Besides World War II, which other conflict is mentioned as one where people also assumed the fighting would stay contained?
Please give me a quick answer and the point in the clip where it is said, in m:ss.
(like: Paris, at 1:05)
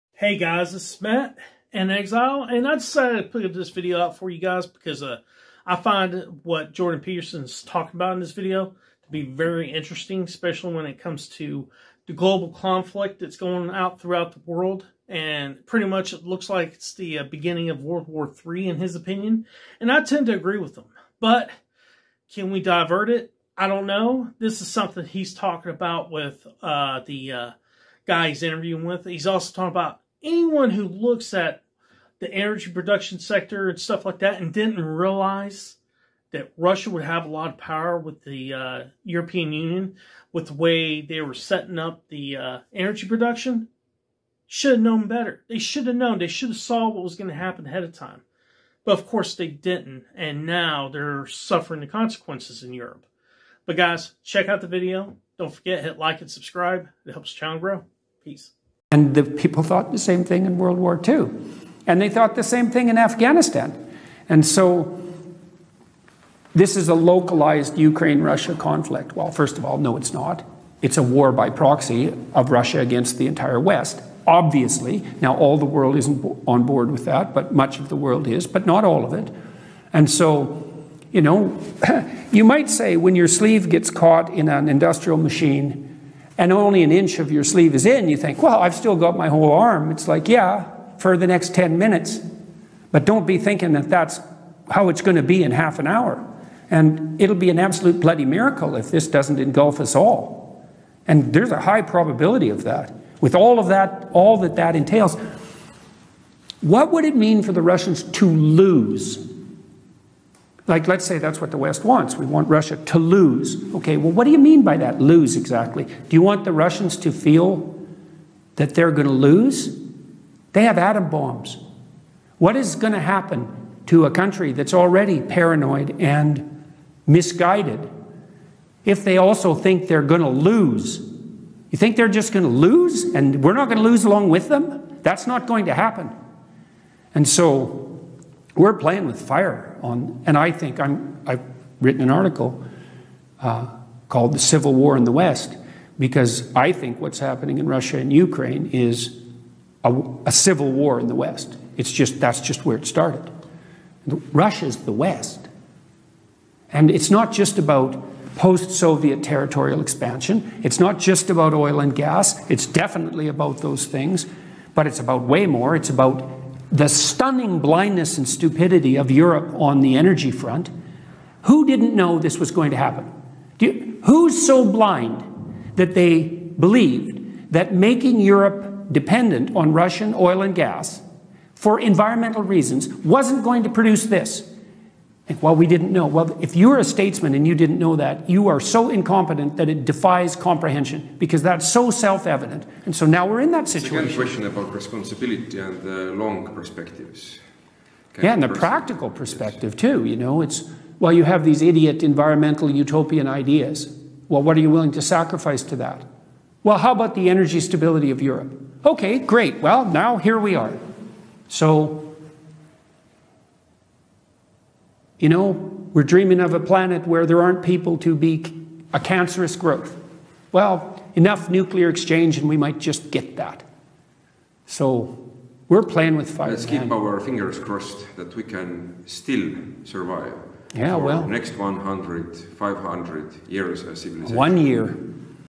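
Afghanistan, at 1:02.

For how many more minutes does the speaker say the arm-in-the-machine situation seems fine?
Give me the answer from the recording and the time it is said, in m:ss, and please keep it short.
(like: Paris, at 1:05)
10 minutes, at 1:31.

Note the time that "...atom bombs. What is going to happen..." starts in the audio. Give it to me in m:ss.
2:00.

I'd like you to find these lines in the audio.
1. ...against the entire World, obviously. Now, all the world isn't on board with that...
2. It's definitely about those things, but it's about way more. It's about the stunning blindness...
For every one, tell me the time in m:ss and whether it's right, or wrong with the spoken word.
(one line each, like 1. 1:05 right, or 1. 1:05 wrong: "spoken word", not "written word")
1. 1:12 wrong: "West", not "World"
2. 2:42 right.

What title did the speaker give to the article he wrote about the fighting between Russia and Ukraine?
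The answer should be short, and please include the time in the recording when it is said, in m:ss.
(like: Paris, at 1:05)
The Civil War in the West, at 2:24.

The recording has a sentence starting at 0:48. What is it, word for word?
But of course they didn't, and now they're suffering the consequences in Europe.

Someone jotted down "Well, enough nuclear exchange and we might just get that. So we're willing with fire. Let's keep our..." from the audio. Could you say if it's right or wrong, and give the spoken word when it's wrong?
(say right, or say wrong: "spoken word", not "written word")
wrong: "playing", not "willing".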